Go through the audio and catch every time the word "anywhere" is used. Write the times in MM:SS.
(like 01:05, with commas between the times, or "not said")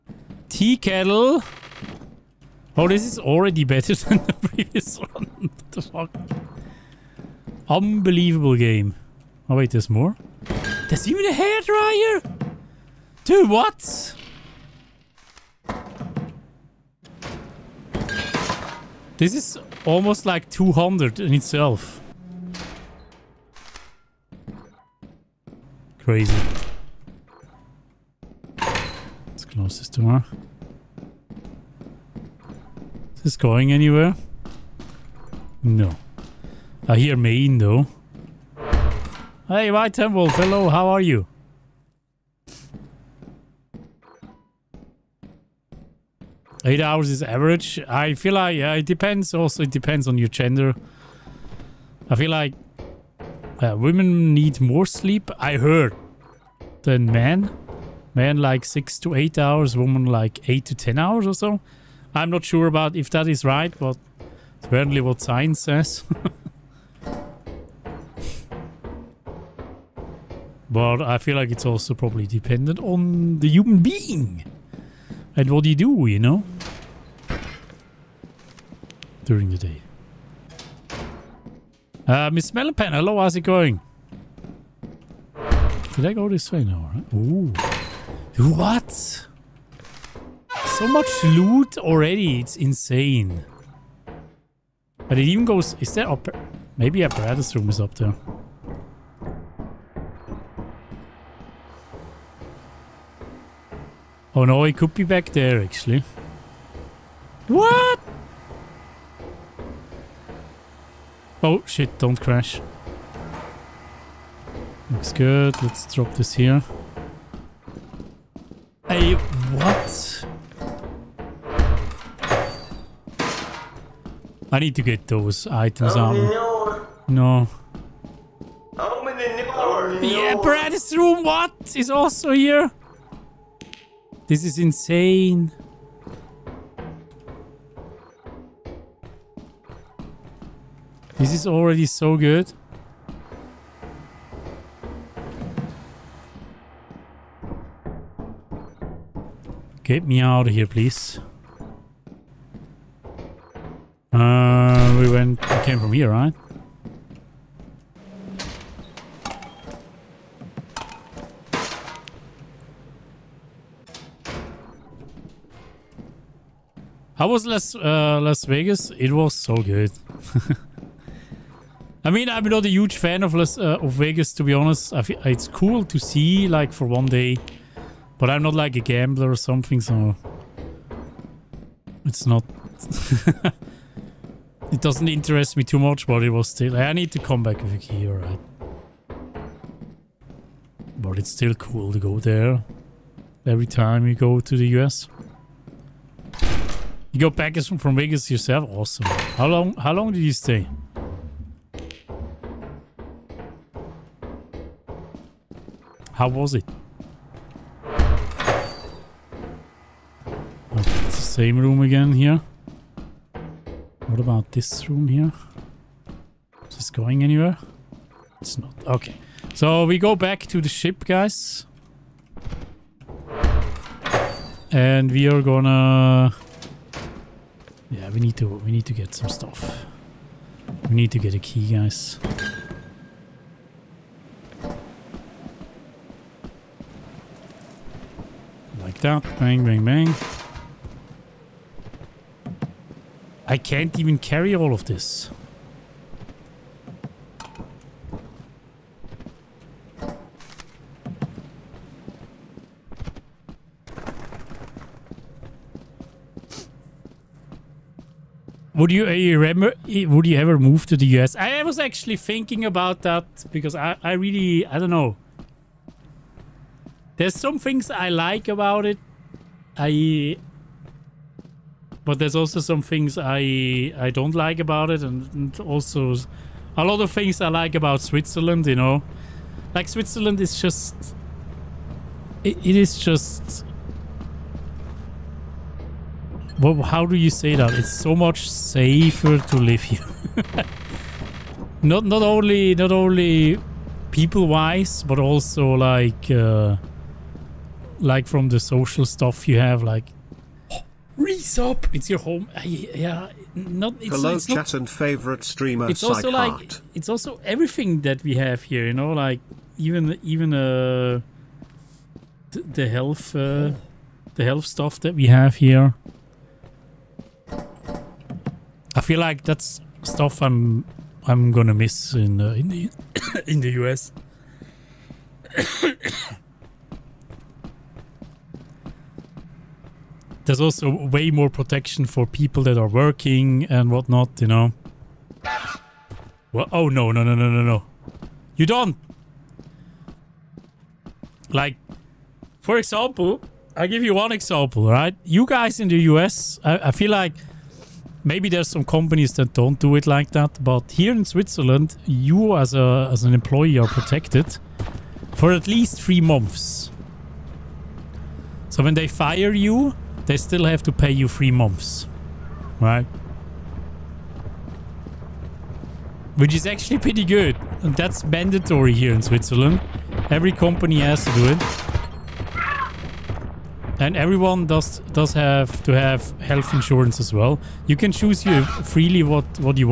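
00:33, 03:37.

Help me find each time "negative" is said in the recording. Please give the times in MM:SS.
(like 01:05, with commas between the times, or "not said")
not said.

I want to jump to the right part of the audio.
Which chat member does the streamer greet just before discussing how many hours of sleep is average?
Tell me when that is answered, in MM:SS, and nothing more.
00:39.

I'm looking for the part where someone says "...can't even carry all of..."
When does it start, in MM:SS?
04:03.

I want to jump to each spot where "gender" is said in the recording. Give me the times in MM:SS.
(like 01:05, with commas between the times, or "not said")
00:50.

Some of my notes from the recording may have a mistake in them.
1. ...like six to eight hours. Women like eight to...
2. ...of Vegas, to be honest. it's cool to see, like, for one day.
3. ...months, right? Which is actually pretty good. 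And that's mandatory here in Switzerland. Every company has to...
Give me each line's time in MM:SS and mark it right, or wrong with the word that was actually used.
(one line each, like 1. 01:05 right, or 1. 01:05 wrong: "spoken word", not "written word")
1. 00:58 right
2. 02:53 right
3. 06:01 right.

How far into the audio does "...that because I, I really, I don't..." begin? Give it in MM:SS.
04:23.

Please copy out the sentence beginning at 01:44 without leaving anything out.
Oh no, he could be back there actually.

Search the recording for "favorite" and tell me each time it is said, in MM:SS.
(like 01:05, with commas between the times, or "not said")
05:04.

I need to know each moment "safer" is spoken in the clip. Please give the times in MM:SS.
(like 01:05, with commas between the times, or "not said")
04:48.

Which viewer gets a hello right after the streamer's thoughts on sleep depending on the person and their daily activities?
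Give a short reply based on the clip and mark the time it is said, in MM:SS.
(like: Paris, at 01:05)
Miss Melonpan, at 01:22.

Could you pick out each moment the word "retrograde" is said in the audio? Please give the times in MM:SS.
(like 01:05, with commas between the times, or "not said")
not said.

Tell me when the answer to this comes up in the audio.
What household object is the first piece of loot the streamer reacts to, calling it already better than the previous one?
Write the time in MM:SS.
00:00.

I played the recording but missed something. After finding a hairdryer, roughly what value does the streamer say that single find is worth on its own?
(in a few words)
200.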